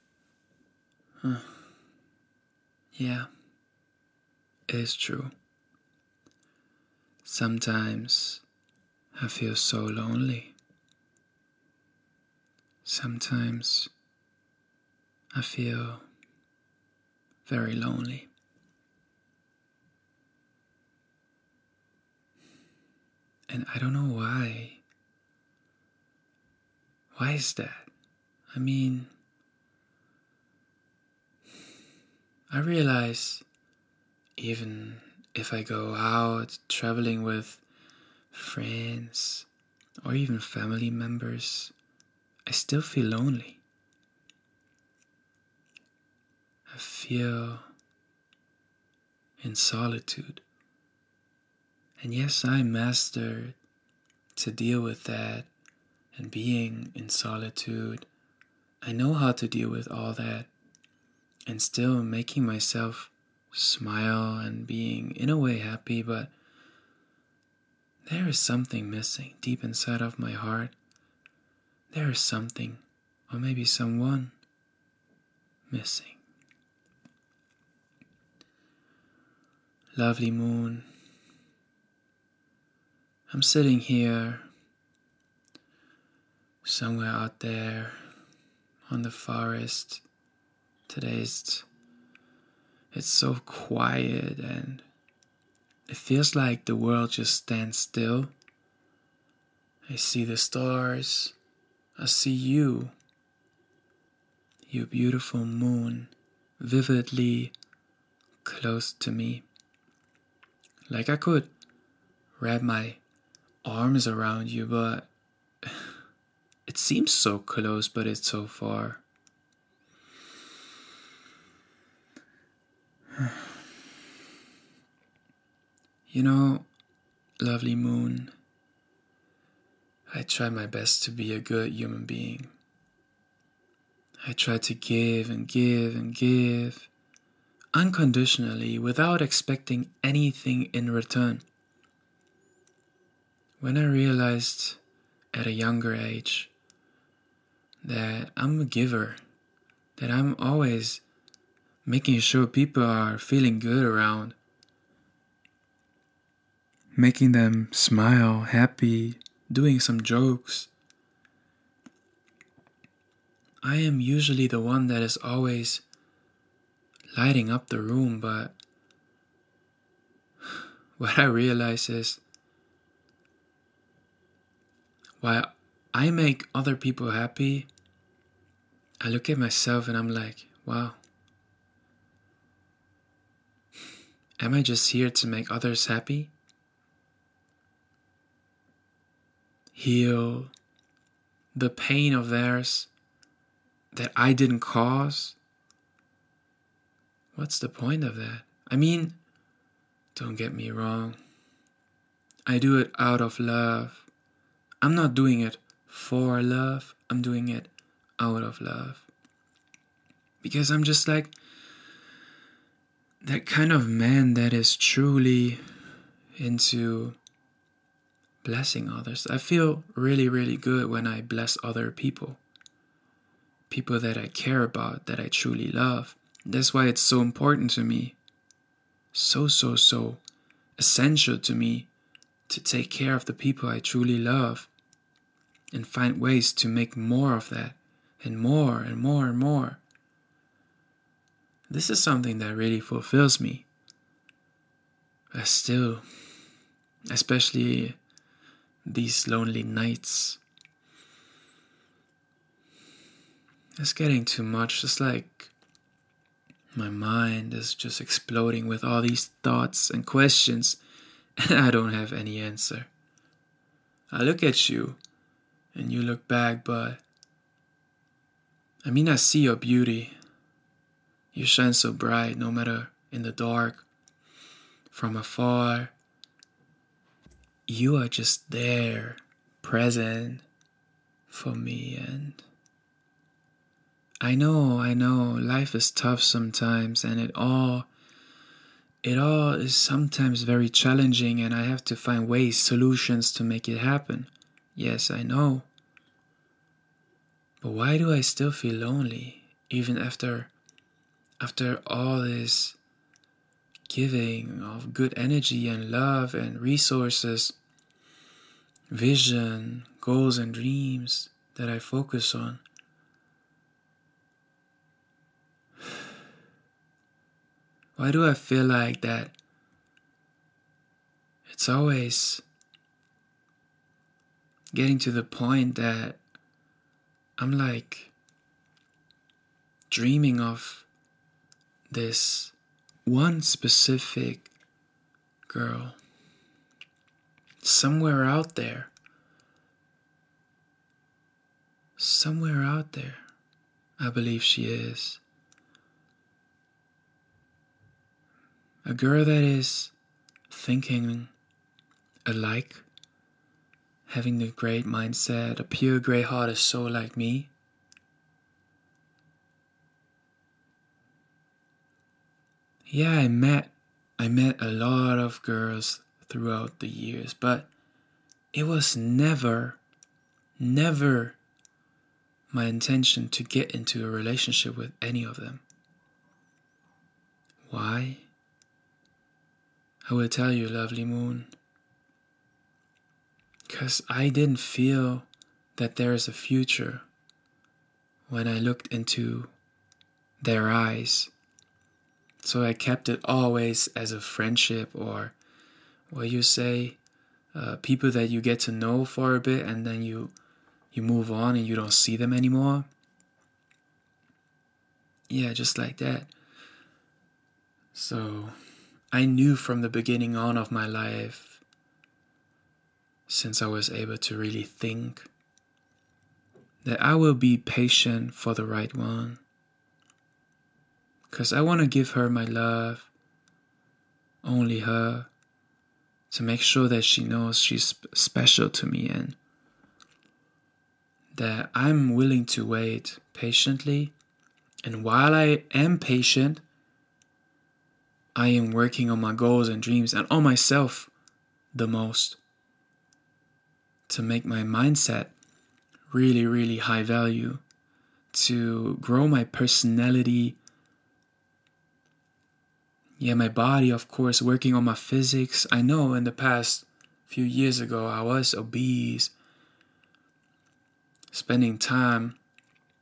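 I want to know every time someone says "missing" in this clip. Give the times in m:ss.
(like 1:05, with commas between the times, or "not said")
1:08, 1:15.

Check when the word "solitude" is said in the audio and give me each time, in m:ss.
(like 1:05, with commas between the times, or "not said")
0:49, 0:57.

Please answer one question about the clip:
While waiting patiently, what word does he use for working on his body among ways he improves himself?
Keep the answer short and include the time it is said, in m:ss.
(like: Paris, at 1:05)
physics, at 7:34.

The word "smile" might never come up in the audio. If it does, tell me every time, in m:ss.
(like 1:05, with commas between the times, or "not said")
1:03, 2:37.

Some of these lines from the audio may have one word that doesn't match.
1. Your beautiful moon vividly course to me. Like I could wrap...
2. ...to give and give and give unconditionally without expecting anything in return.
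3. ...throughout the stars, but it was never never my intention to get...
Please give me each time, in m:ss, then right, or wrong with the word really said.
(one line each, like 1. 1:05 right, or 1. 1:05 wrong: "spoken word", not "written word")
1. 1:44 wrong: "close", not "course"
2. 2:14 right
3. 6:06 wrong: "years", not "stars".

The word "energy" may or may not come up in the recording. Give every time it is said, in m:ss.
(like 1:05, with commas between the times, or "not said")
5:05.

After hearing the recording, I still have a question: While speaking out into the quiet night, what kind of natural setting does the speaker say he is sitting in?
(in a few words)
forest.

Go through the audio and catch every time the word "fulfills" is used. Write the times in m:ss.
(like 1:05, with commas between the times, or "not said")
4:02.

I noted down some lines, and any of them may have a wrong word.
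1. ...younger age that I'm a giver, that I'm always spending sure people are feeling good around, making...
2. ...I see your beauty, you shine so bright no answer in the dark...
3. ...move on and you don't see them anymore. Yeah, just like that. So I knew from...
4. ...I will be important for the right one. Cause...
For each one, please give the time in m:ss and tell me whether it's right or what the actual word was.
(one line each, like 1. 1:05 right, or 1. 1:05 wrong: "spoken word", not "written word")
1. 2:25 wrong: "making", not "spending"
2. 4:29 wrong: "matter", not "answer"
3. 6:41 right
4. 6:57 wrong: "patient", not "important".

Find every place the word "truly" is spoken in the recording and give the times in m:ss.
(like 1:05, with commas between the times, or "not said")
3:34, 3:45, 3:53.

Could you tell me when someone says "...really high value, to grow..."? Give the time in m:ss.
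7:26.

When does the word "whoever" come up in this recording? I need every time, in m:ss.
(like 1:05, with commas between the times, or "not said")
not said.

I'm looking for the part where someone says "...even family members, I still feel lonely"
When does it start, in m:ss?
0:40.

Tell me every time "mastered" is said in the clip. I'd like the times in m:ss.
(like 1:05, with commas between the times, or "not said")
0:52.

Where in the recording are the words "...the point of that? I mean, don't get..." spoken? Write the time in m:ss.
3:17.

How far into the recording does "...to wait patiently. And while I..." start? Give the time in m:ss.
7:12.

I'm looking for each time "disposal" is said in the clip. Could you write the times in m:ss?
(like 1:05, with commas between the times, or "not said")
not said.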